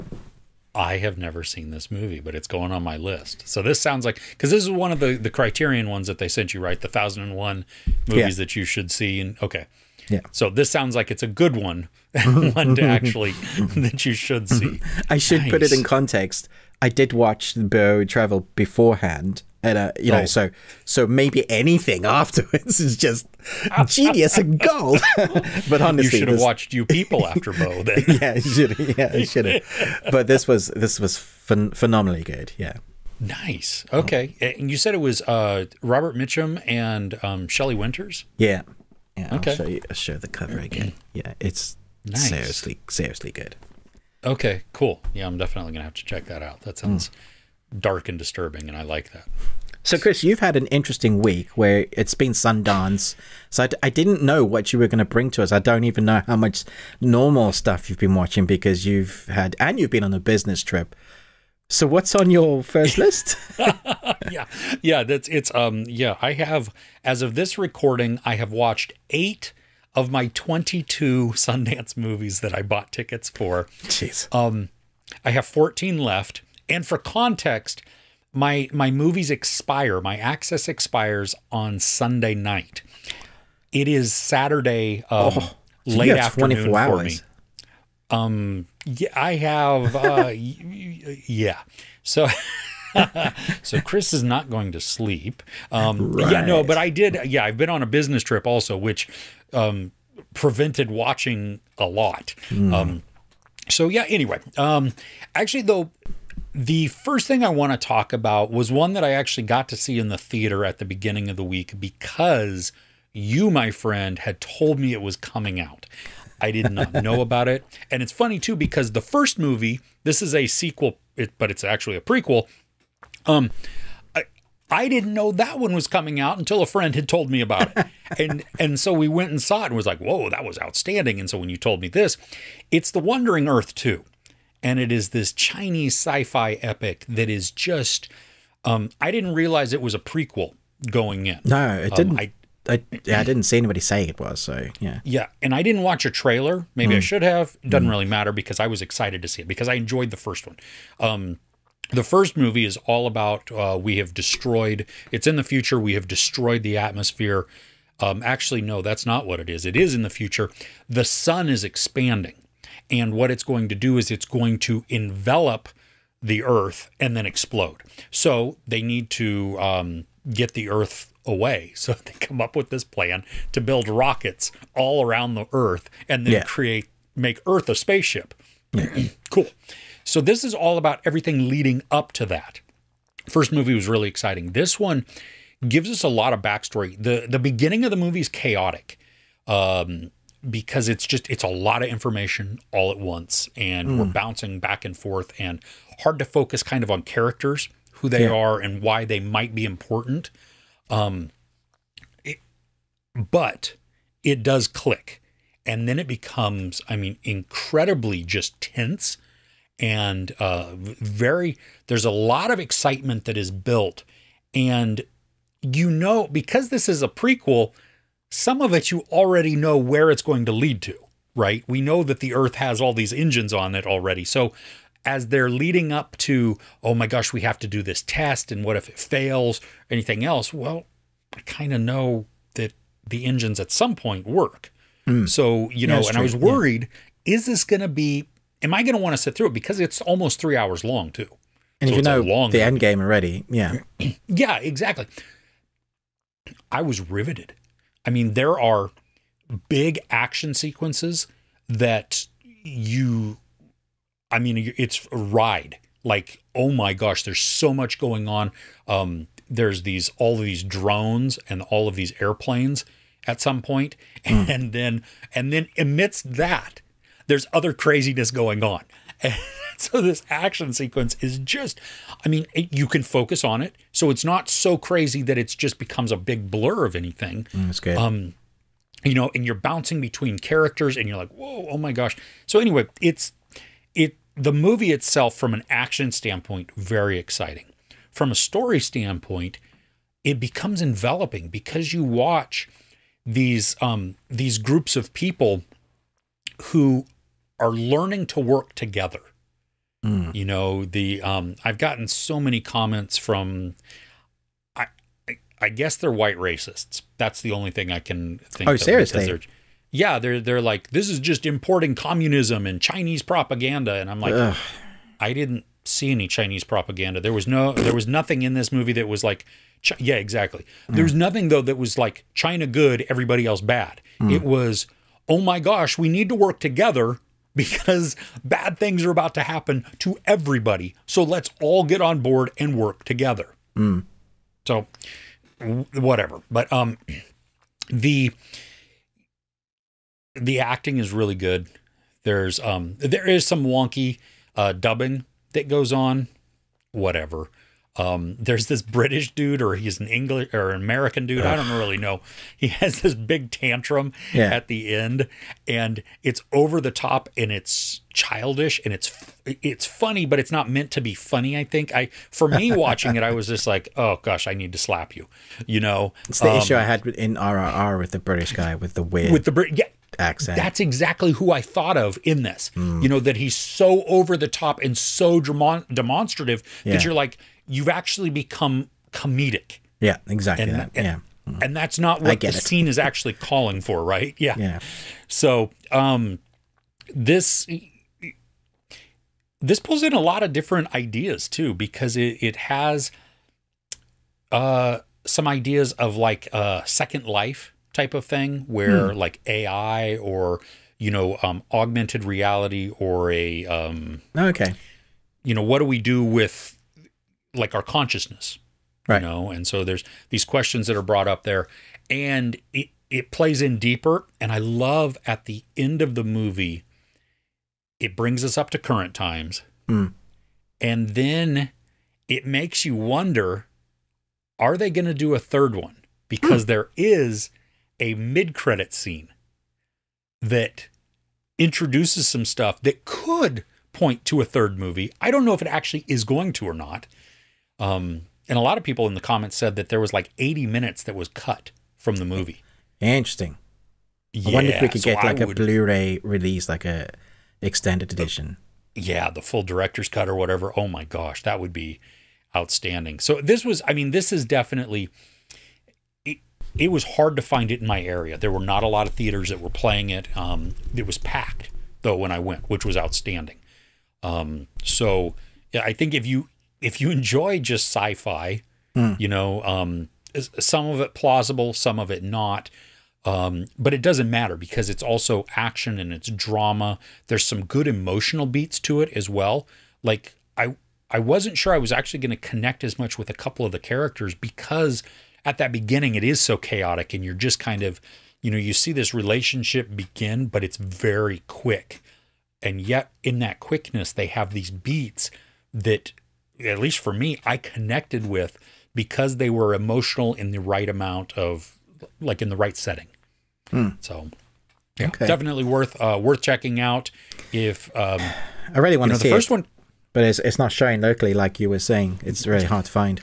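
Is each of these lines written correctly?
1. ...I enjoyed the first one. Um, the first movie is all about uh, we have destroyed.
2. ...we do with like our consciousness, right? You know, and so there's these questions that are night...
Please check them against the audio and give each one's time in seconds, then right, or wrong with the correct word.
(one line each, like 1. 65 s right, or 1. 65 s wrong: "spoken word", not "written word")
1. 149 s right
2. 405 s wrong: "brought", not "night".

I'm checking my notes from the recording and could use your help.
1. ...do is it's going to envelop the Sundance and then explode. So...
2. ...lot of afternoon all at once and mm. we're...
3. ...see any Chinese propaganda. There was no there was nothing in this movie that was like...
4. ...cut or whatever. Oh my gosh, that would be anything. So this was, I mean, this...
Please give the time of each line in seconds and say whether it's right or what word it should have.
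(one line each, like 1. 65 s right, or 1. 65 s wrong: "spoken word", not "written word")
1. 163 s wrong: "Earth", not "Sundance"
2. 191 s wrong: "information", not "afternoon"
3. 315 s right
4. 450 s wrong: "outstanding", not "anything".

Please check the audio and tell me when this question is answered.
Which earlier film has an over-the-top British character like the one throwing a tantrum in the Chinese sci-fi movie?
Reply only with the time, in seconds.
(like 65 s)
367 s.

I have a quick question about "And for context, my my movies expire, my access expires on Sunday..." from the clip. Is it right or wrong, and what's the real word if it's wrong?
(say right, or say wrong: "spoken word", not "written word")
right.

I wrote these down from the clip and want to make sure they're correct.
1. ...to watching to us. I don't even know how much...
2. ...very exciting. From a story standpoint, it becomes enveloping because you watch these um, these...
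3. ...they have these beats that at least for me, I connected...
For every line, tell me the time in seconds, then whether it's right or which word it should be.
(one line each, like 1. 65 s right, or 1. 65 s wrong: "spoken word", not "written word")
1. 54 s wrong: "bring", not "watching"
2. 286 s right
3. 494 s right.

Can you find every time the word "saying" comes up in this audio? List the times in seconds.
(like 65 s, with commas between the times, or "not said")
143 s, 511 s.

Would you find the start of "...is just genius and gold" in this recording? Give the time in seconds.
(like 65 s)
22 s.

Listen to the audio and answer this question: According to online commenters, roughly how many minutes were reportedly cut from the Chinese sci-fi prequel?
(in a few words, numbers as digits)
80.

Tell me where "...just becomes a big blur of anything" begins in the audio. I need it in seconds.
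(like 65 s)
275 s.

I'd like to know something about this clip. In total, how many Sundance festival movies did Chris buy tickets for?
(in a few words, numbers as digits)
22.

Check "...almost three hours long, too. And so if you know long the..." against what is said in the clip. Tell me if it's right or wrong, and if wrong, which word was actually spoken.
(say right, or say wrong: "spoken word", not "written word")
right.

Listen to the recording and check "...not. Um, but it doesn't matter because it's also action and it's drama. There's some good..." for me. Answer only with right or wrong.
right.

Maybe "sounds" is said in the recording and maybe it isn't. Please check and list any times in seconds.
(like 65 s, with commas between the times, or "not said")
3 s, 10 s, 46 s.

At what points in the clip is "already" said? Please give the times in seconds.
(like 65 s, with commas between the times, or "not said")
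219 s, 223 s, 242 s.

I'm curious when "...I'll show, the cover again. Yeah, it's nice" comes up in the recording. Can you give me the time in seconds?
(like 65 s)
39 s.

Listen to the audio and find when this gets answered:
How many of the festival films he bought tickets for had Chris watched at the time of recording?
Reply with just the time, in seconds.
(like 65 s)
69 s.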